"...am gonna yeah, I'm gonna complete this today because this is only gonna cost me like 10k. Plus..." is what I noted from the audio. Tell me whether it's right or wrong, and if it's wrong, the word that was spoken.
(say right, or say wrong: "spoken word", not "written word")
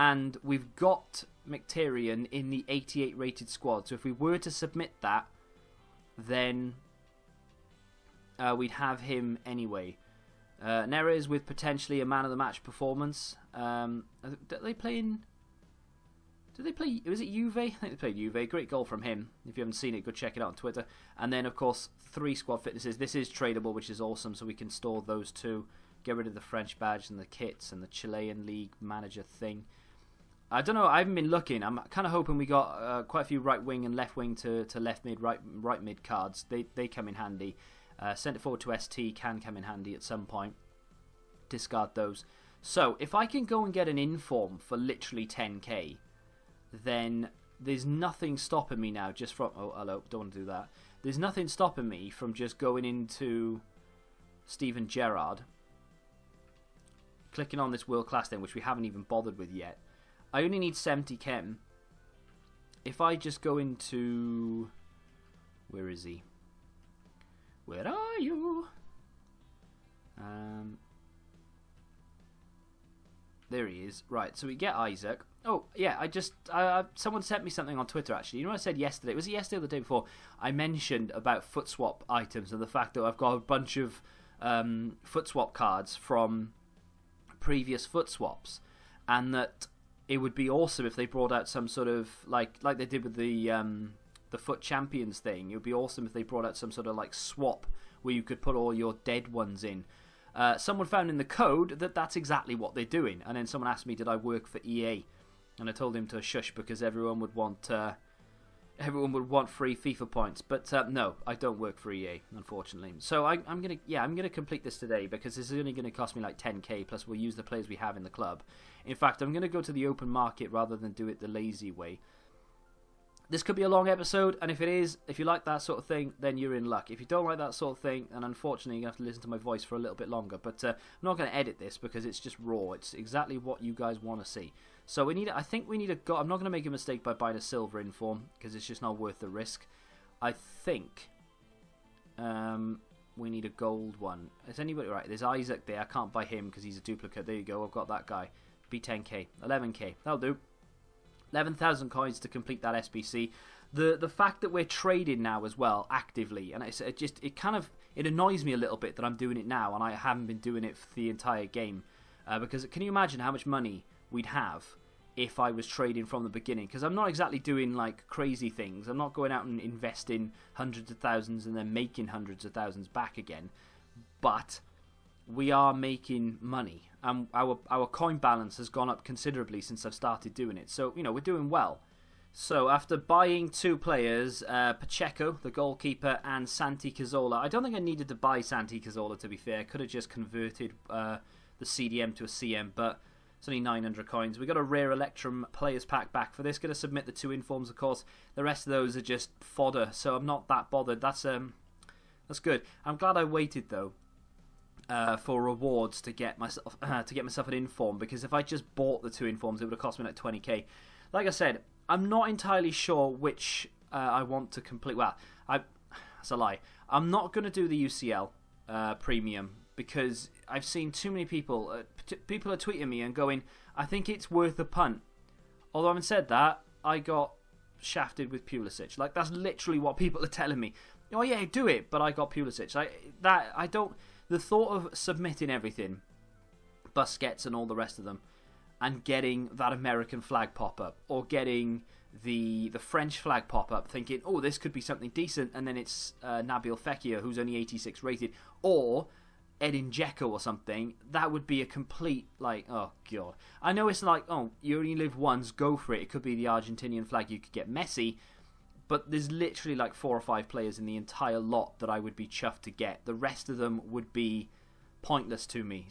right.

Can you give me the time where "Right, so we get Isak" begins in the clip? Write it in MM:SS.
01:14.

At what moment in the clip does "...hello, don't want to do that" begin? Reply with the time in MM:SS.
00:49.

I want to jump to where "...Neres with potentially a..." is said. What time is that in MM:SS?
00:10.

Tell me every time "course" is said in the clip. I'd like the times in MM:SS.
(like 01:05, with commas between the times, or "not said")
00:21, 03:17.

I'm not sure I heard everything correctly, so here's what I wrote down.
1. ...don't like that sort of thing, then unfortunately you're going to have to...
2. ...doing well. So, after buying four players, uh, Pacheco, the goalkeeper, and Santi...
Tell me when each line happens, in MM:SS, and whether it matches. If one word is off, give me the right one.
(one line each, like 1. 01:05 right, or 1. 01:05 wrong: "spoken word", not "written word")
1. 02:07 right
2. 03:01 wrong: "two", not "four".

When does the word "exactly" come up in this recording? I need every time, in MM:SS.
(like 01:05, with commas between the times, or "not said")
01:42, 02:12, 02:47.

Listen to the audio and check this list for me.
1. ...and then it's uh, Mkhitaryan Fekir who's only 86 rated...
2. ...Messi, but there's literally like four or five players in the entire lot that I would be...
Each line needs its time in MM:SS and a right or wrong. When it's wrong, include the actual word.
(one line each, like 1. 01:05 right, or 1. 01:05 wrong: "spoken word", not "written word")
1. 04:05 wrong: "Nabil", not "Mkhitaryan"
2. 04:17 right.